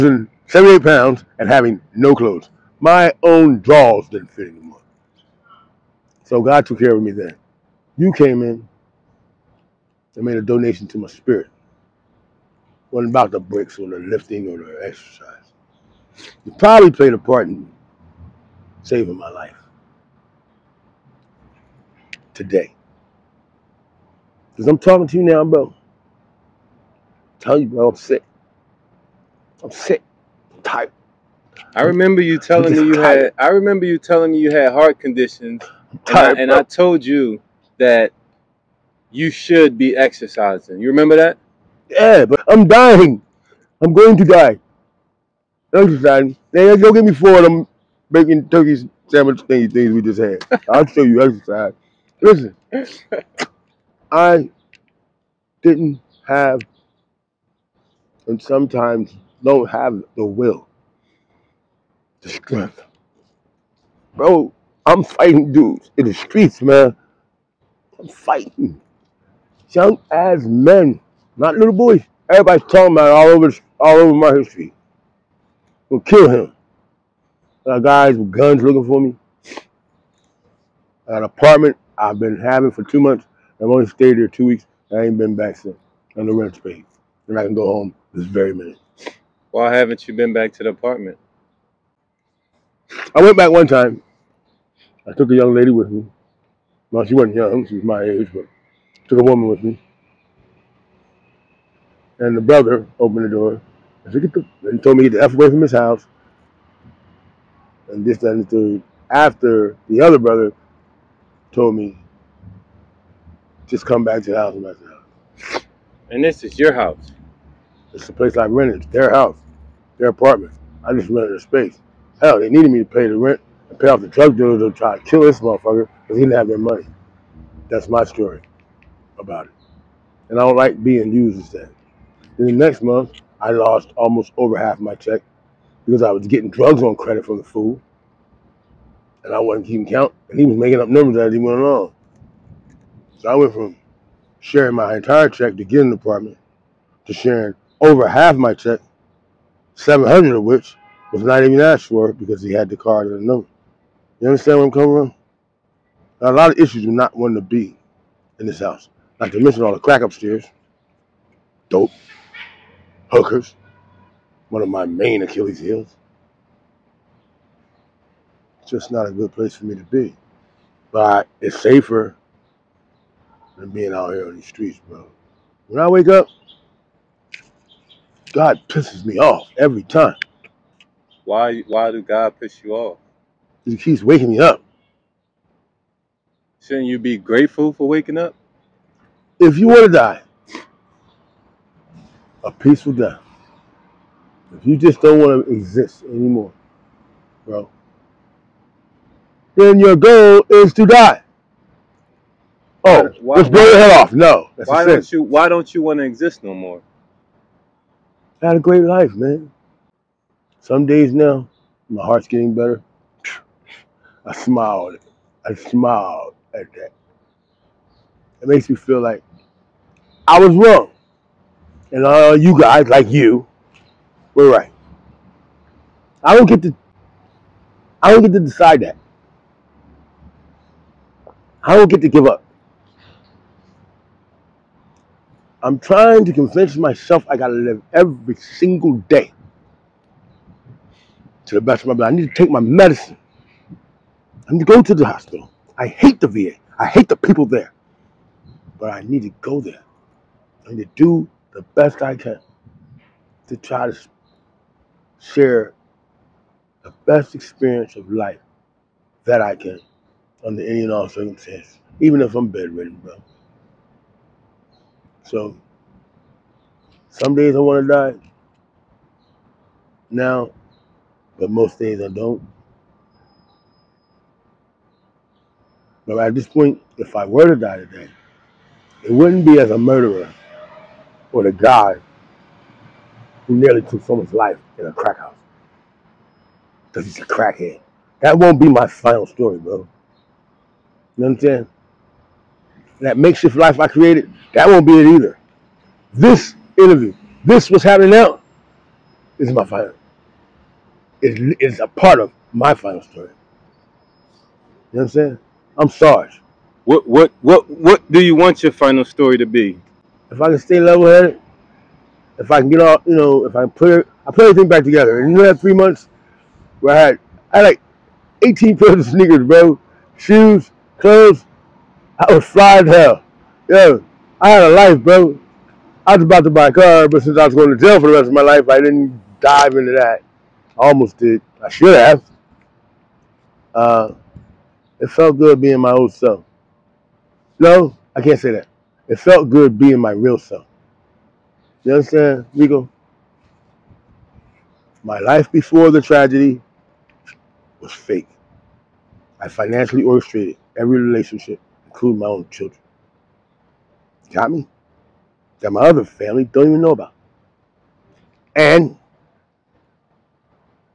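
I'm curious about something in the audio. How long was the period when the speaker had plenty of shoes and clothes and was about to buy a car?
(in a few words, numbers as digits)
3 months.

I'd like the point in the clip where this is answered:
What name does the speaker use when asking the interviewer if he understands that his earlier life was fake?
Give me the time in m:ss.
5:42.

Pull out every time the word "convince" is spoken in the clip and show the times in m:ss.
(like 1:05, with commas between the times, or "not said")
3:56.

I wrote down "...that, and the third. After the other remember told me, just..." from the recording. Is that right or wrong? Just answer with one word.
wrong.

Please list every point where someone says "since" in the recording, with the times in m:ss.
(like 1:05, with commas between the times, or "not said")
1:25, 5:27.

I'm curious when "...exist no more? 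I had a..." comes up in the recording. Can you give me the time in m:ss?
3:26.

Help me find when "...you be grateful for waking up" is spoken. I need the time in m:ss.
3:06.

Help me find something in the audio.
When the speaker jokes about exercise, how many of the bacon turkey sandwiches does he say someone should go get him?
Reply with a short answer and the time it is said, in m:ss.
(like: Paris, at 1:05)
4, at 0:47.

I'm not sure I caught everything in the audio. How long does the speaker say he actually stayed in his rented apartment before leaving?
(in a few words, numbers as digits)
2 weeks.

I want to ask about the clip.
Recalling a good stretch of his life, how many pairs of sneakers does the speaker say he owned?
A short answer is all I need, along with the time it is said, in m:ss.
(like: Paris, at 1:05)
18, at 5:18.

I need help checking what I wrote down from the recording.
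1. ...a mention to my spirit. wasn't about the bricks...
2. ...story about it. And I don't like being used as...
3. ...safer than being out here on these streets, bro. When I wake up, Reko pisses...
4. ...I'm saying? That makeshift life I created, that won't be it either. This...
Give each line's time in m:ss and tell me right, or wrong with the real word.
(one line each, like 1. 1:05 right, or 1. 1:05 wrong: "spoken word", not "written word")
1. 0:10 wrong: "donation", not "mention"
2. 2:08 right
3. 2:51 wrong: "God", not "Reko"
4. 4:51 right.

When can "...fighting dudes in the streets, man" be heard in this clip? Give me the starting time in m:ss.
1:05.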